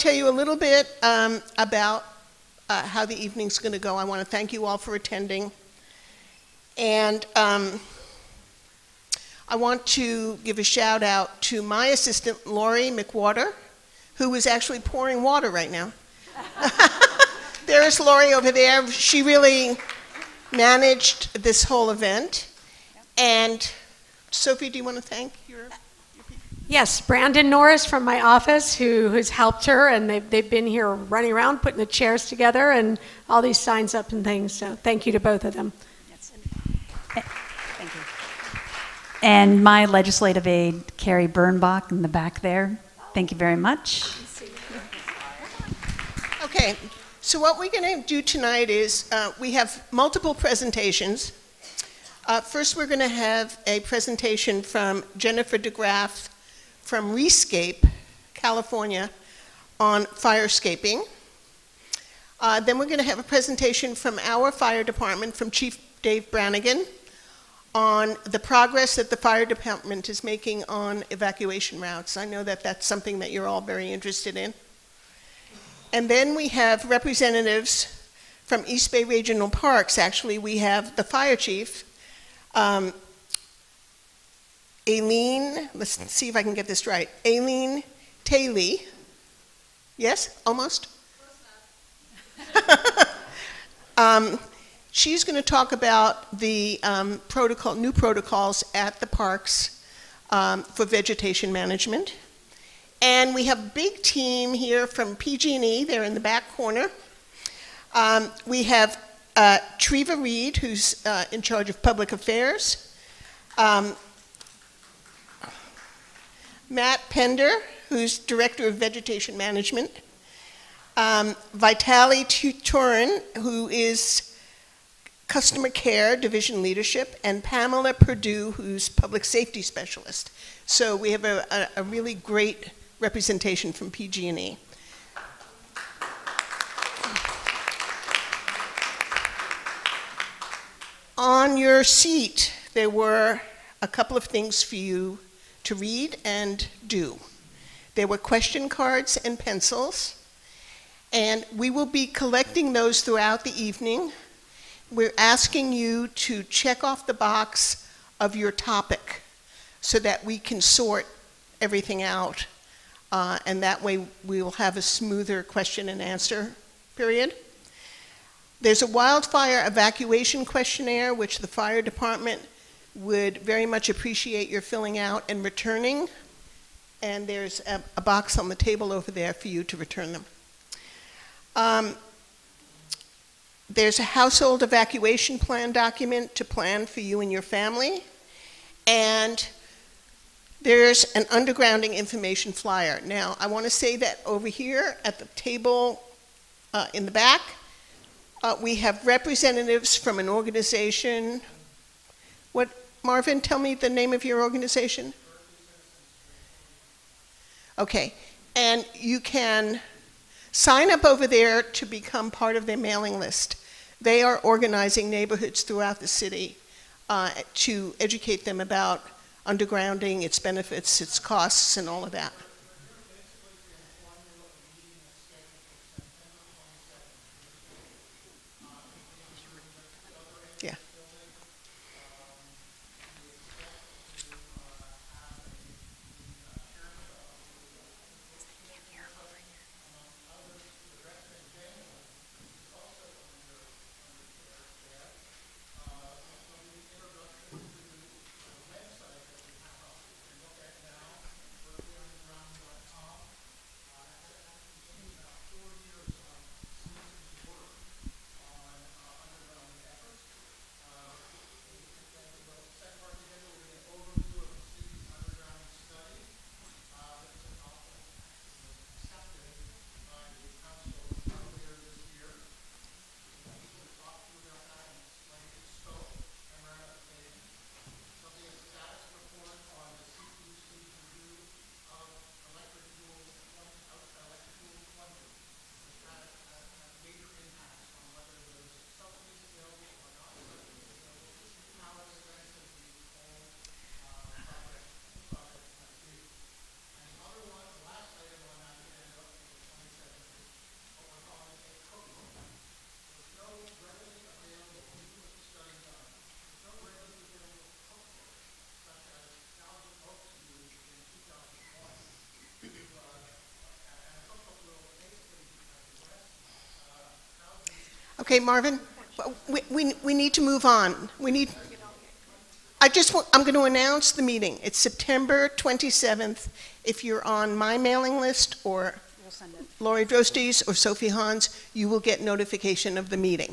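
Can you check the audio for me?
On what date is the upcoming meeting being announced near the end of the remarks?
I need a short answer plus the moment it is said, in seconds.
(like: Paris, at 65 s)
September 27th, at 324 s.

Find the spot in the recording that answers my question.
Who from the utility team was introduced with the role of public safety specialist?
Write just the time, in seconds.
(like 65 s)
127 s.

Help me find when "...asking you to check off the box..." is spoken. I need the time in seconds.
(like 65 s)
155 s.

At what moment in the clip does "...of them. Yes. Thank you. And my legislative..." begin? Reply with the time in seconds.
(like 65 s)
35 s.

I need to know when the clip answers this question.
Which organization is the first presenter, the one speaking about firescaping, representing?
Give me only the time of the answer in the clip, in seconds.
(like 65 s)
57 s.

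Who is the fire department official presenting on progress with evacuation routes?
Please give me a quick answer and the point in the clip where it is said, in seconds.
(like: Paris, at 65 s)
Dave Brannigan, at 66 s.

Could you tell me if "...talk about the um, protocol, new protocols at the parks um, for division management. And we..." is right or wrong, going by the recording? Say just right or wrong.
wrong.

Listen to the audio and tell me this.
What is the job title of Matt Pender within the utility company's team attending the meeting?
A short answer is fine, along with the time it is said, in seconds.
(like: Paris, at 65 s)
Director of vegetation management, at 118 s.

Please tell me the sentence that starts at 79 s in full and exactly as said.
Actually, we have the fire chief, um, Aileen, let's see if I can get this right, Aileen Taylor.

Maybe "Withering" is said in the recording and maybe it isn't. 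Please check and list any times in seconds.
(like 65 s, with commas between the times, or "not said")
not said.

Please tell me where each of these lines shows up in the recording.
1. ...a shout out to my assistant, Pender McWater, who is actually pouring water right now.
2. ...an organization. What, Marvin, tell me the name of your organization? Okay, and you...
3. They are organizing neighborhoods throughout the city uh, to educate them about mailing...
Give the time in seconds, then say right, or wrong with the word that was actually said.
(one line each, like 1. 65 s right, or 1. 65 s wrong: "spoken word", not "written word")
1. 10 s wrong: "Lori", not "Pender"
2. 200 s right
3. 214 s wrong: "undergrounding", not "mailing".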